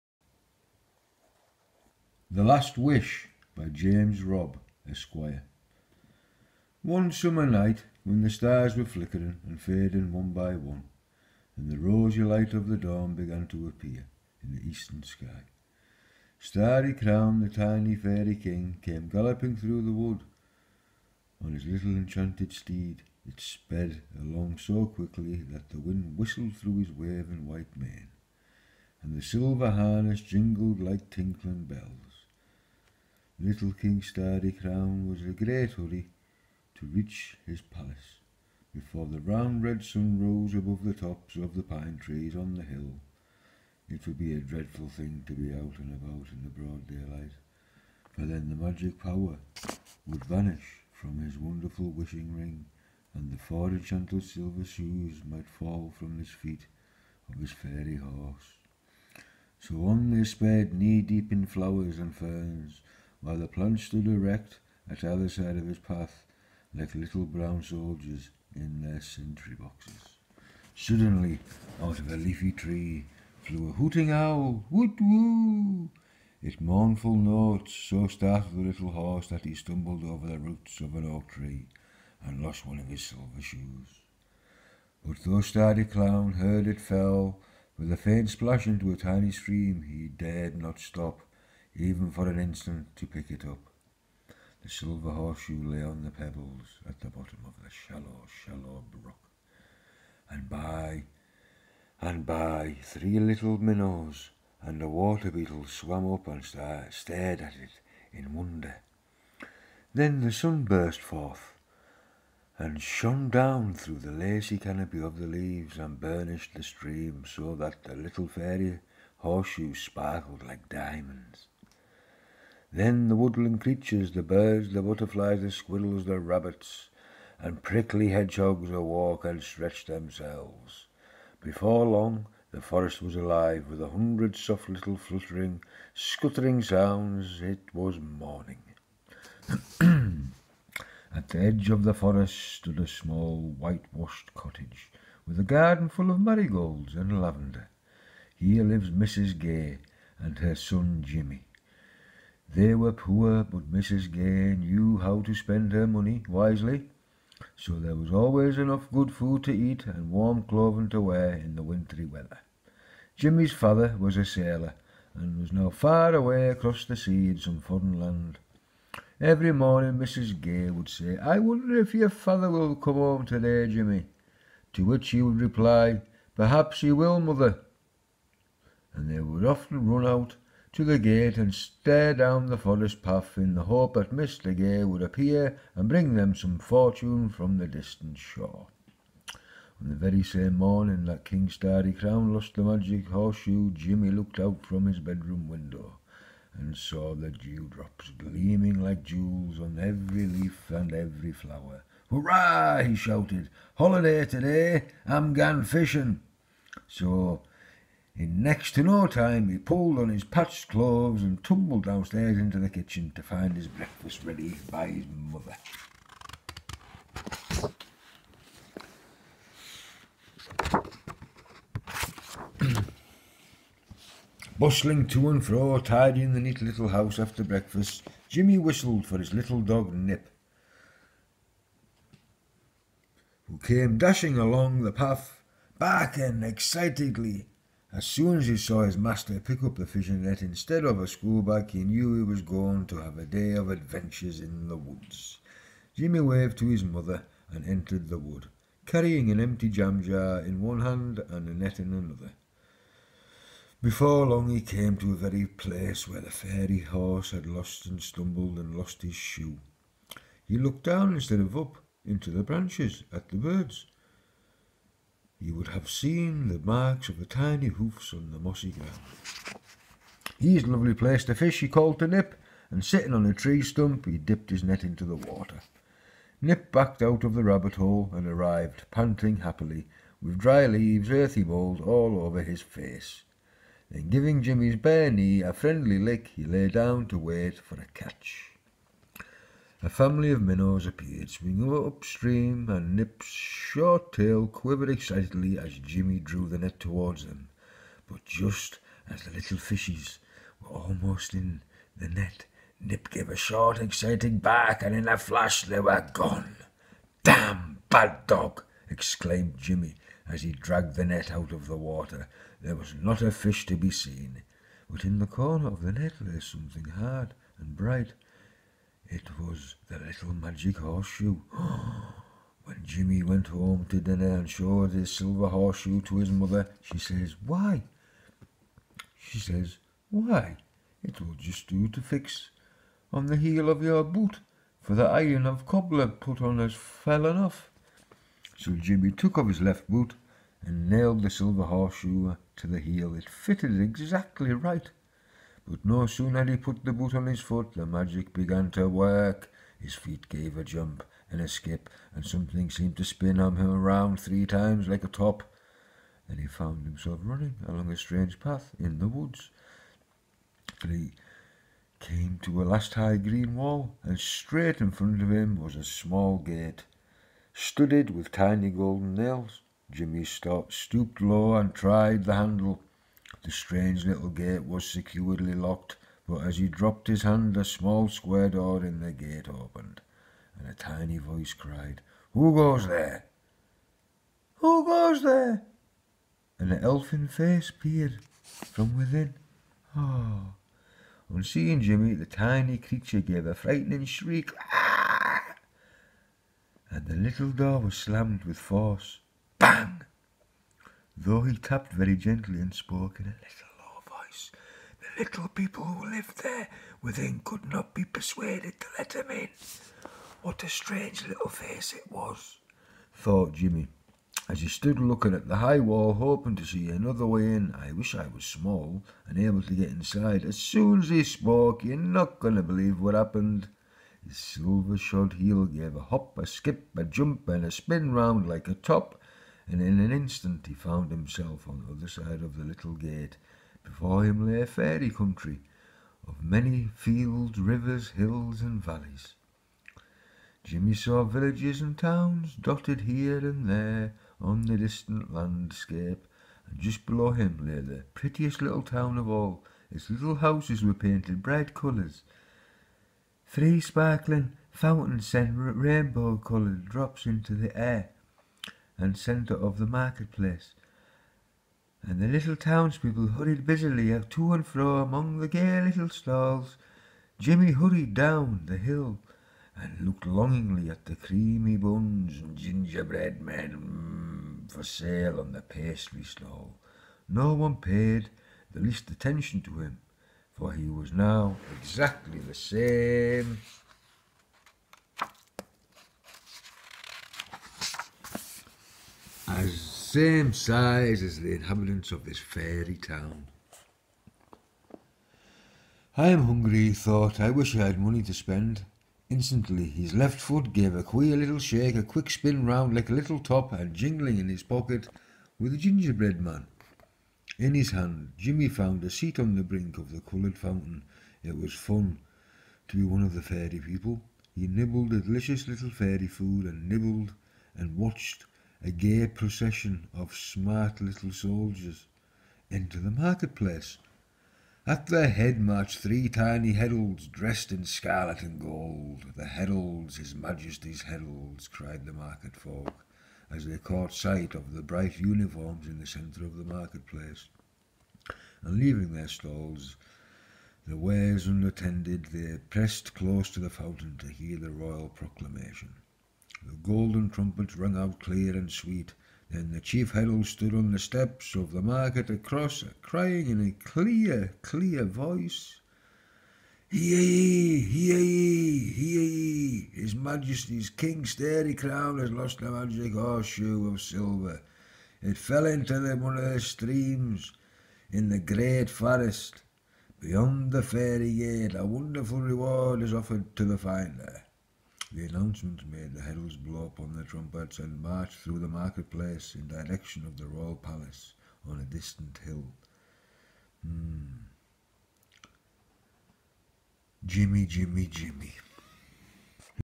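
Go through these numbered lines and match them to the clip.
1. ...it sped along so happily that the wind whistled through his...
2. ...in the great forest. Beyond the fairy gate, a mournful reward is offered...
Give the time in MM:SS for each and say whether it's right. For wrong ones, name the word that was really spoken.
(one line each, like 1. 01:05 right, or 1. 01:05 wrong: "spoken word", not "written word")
1. 00:23 wrong: "quickly", not "happily"
2. 09:28 wrong: "wonderful", not "mournful".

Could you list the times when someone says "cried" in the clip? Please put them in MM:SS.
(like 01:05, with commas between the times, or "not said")
06:21, 08:51.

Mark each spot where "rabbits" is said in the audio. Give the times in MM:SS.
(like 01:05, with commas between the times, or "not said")
02:06, 04:37.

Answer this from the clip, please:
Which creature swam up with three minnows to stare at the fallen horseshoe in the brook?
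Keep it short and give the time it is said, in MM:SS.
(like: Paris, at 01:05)
A water beetle, at 01:44.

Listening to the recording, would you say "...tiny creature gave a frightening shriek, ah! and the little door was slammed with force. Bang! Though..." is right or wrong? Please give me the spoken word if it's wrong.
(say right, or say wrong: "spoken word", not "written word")
right.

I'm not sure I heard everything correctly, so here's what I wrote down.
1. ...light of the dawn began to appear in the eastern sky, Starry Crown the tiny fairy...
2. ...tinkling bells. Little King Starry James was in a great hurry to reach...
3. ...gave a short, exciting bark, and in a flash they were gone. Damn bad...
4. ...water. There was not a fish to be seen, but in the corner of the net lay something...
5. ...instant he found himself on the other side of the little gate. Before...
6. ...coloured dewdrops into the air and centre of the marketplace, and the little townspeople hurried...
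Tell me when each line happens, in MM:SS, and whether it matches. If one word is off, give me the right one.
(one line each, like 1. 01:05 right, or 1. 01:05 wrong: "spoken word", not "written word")
1. 00:12 right
2. 00:31 wrong: "Crown", not "James"
3. 05:03 right
4. 05:11 right
5. 07:10 right
6. 07:36 wrong: "drops", not "dewdrops".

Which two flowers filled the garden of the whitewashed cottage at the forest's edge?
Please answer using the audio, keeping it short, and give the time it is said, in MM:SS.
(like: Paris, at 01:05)
Marigolds and lavender, at 02:26.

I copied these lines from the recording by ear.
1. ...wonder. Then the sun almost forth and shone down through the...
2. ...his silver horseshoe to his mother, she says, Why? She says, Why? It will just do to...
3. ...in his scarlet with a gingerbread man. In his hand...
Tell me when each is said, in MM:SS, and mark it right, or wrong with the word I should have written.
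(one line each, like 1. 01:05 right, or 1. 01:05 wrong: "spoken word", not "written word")
1. 01:48 wrong: "burst", not "almost"
2. 05:24 right
3. 08:24 wrong: "pocket", not "scarlet".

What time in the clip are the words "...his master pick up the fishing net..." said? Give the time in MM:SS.
03:58.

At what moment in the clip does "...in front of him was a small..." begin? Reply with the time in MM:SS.
06:04.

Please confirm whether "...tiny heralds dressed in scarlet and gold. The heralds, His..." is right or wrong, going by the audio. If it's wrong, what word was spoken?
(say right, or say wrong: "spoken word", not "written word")
right.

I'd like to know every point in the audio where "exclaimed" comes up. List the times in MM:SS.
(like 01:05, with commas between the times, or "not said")
05:08.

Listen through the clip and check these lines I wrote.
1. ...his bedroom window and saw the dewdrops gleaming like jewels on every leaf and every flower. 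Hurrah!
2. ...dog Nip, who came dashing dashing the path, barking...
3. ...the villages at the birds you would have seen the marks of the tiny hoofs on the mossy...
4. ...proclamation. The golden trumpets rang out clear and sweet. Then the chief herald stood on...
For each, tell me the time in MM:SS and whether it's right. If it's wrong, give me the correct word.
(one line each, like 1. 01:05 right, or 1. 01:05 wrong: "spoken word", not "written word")
1. 03:14 right
2. 03:49 wrong: "along", not "dashing"
3. 04:22 wrong: "branches", not "villages"
4. 09:05 right.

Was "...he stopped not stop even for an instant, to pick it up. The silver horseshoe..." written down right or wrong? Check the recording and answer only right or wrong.
wrong.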